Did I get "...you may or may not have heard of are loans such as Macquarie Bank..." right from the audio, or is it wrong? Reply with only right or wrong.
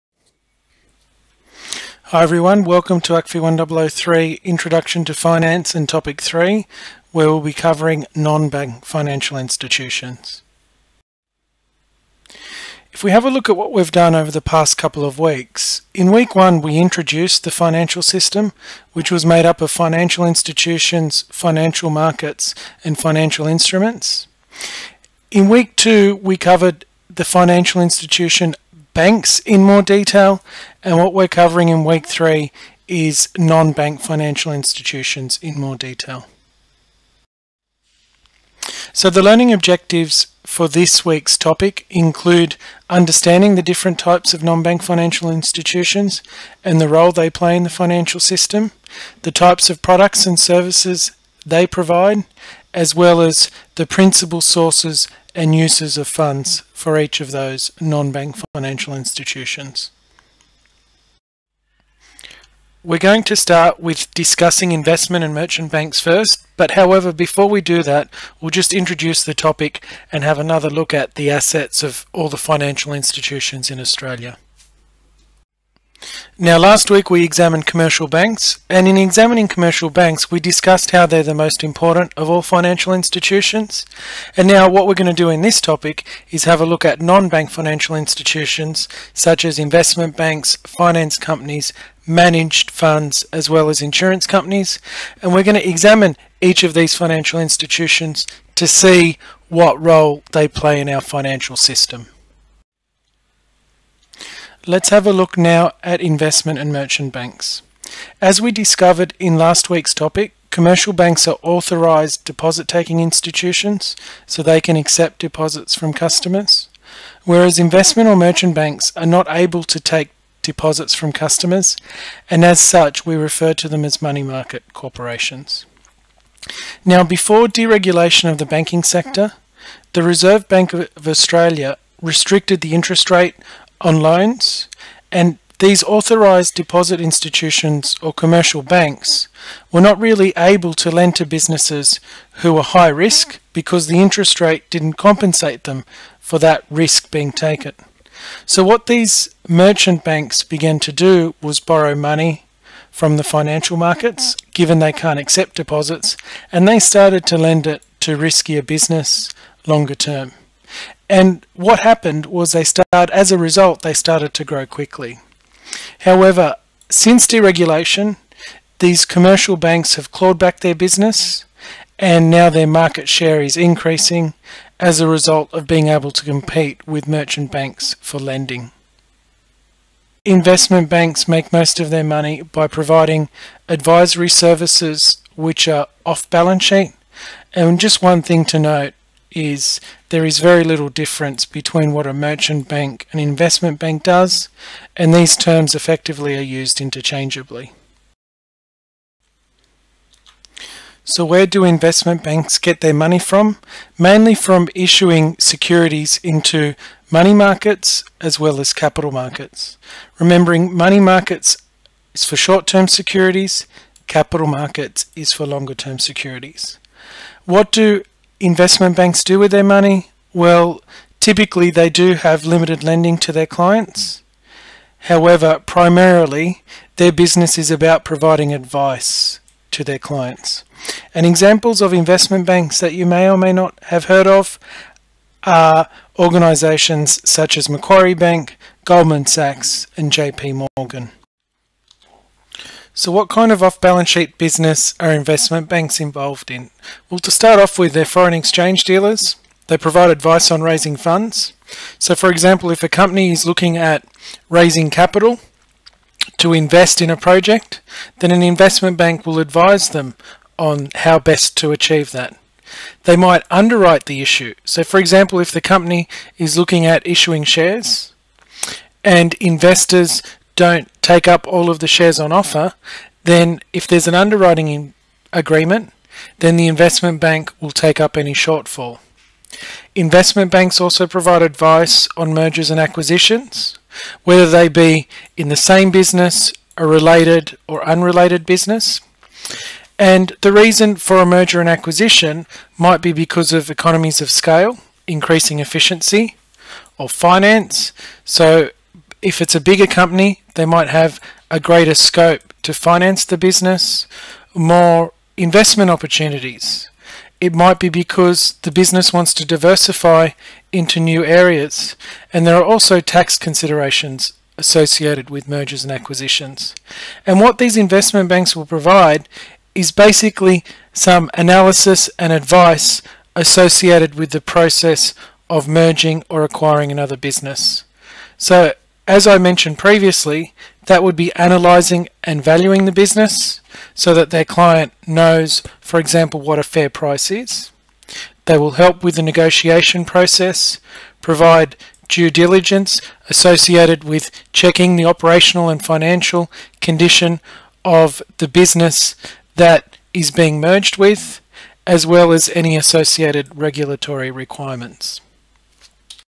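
wrong.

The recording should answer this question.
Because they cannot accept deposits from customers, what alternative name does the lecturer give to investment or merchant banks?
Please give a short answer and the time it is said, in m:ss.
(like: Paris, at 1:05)
money market corporations, at 2:03.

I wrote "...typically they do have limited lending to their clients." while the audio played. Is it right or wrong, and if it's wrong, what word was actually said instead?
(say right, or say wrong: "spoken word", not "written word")
right.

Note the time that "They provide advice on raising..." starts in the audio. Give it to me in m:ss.
4:09.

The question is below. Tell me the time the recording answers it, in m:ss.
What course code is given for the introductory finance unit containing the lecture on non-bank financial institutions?
0:03.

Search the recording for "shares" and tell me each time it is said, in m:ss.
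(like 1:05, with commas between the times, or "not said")
2:53, 4:27, 4:31.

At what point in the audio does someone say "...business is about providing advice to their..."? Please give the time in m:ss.
3:47.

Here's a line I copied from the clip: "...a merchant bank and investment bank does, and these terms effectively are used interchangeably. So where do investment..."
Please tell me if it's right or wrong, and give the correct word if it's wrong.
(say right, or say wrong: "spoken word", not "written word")
right.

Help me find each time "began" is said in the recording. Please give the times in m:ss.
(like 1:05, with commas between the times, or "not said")
2:30.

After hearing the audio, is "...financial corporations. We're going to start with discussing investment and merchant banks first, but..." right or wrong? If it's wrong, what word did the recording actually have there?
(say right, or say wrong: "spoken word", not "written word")
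wrong: "institutions", not "corporations".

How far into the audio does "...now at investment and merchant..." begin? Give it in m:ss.
1:45.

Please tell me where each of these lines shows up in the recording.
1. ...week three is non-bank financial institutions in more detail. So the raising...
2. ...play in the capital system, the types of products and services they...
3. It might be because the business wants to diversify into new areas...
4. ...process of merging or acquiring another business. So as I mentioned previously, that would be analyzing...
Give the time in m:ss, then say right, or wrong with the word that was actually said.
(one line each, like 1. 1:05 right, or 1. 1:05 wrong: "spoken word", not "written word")
1. 0:31 wrong: "learning", not "raising"
2. 0:47 wrong: "financial", not "capital"
3. 5:07 right
4. 5:24 right.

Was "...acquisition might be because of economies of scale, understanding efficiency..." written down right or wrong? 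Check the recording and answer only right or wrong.
wrong.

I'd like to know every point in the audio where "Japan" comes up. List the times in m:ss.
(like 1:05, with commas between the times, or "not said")
not said.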